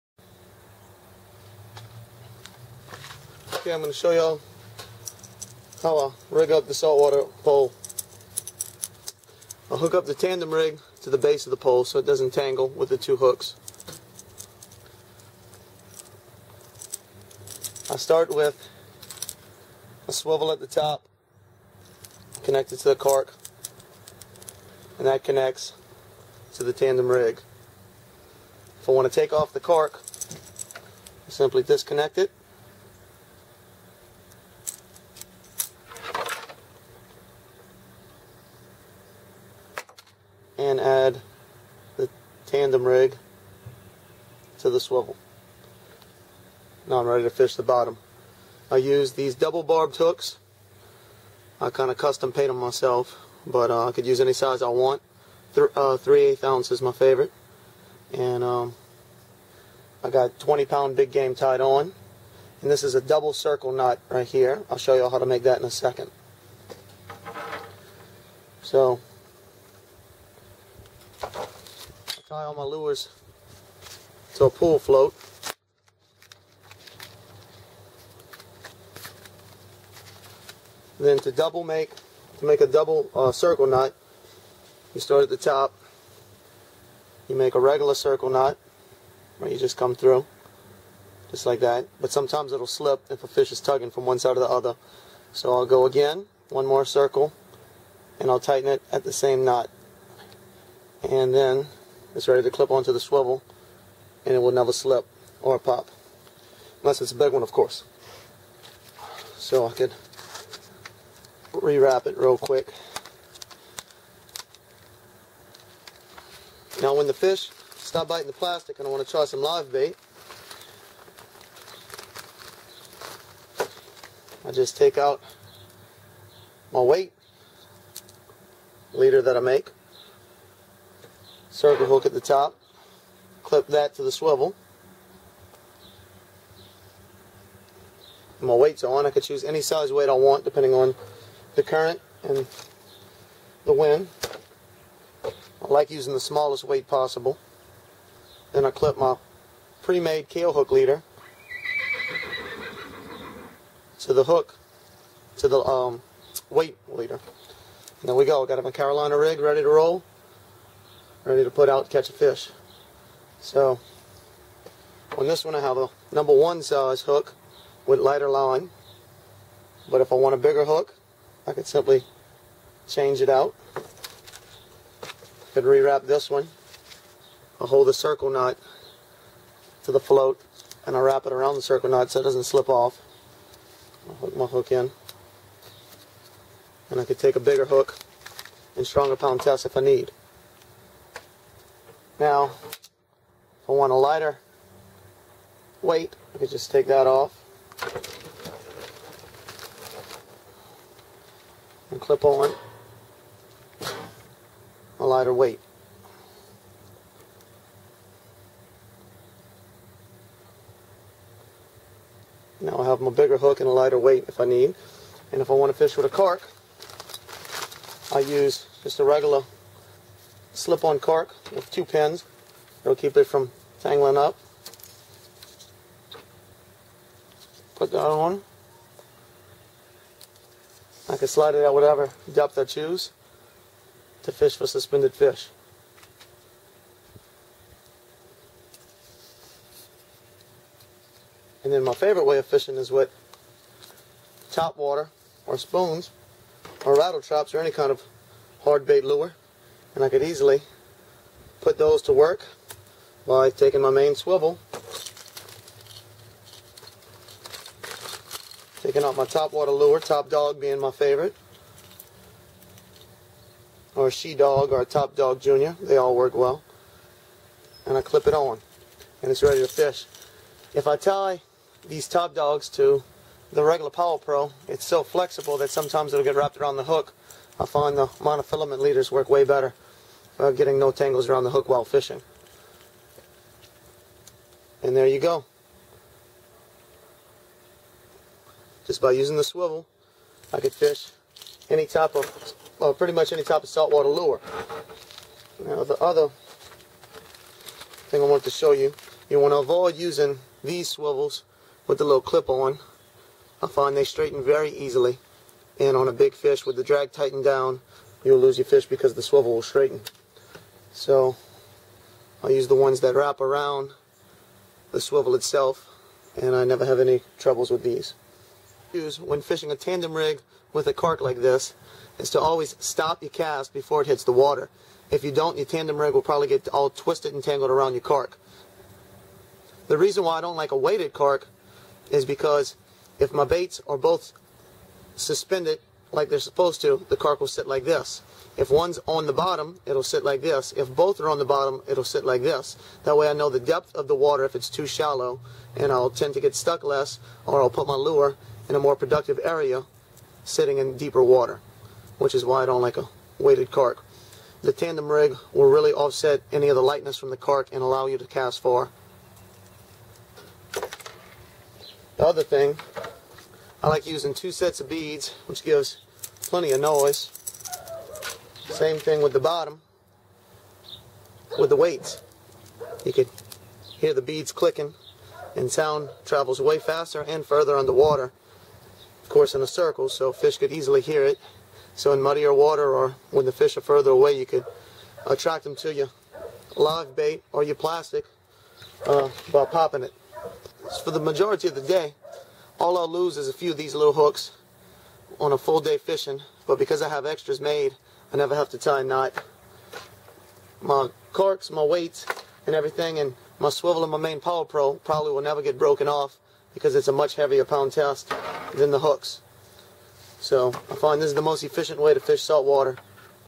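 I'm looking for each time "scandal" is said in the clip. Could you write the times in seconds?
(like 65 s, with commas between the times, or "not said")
not said.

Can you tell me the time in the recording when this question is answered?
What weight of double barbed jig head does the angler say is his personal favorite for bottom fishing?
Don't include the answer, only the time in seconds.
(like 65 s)
55 s.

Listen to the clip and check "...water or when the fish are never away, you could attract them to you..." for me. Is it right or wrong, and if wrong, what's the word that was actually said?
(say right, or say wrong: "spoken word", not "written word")
wrong: "further", not "never".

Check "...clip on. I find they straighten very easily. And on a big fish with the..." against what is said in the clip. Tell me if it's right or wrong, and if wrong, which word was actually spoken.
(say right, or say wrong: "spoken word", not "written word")
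right.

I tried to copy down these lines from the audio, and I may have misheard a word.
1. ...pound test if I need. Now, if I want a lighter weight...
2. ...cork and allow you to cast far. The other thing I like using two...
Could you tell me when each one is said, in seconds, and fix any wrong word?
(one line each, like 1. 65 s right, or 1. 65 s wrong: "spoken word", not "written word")
1. 189 s right
2. 357 s right.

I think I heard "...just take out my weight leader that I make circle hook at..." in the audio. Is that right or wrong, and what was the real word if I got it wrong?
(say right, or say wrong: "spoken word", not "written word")
right.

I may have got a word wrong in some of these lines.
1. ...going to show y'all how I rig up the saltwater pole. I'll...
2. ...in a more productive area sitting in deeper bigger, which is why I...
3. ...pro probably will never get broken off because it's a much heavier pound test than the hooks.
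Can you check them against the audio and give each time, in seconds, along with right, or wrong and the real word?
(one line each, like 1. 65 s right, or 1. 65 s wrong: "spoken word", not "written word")
1. 3 s right
2. 348 s wrong: "water", not "bigger"
3. 404 s right.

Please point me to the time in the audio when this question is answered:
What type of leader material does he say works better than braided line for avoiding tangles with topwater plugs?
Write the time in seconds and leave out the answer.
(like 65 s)
278 s.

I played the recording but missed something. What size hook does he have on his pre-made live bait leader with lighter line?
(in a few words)
Number 1.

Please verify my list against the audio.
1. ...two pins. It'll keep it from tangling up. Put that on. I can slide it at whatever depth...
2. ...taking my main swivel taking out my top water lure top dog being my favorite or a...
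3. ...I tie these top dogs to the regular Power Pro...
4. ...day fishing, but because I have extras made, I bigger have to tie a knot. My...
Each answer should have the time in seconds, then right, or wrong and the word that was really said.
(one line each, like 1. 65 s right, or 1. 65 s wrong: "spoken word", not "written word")
1. 221 s right
2. 253 s right
3. 270 s right
4. 395 s wrong: "never", not "bigger".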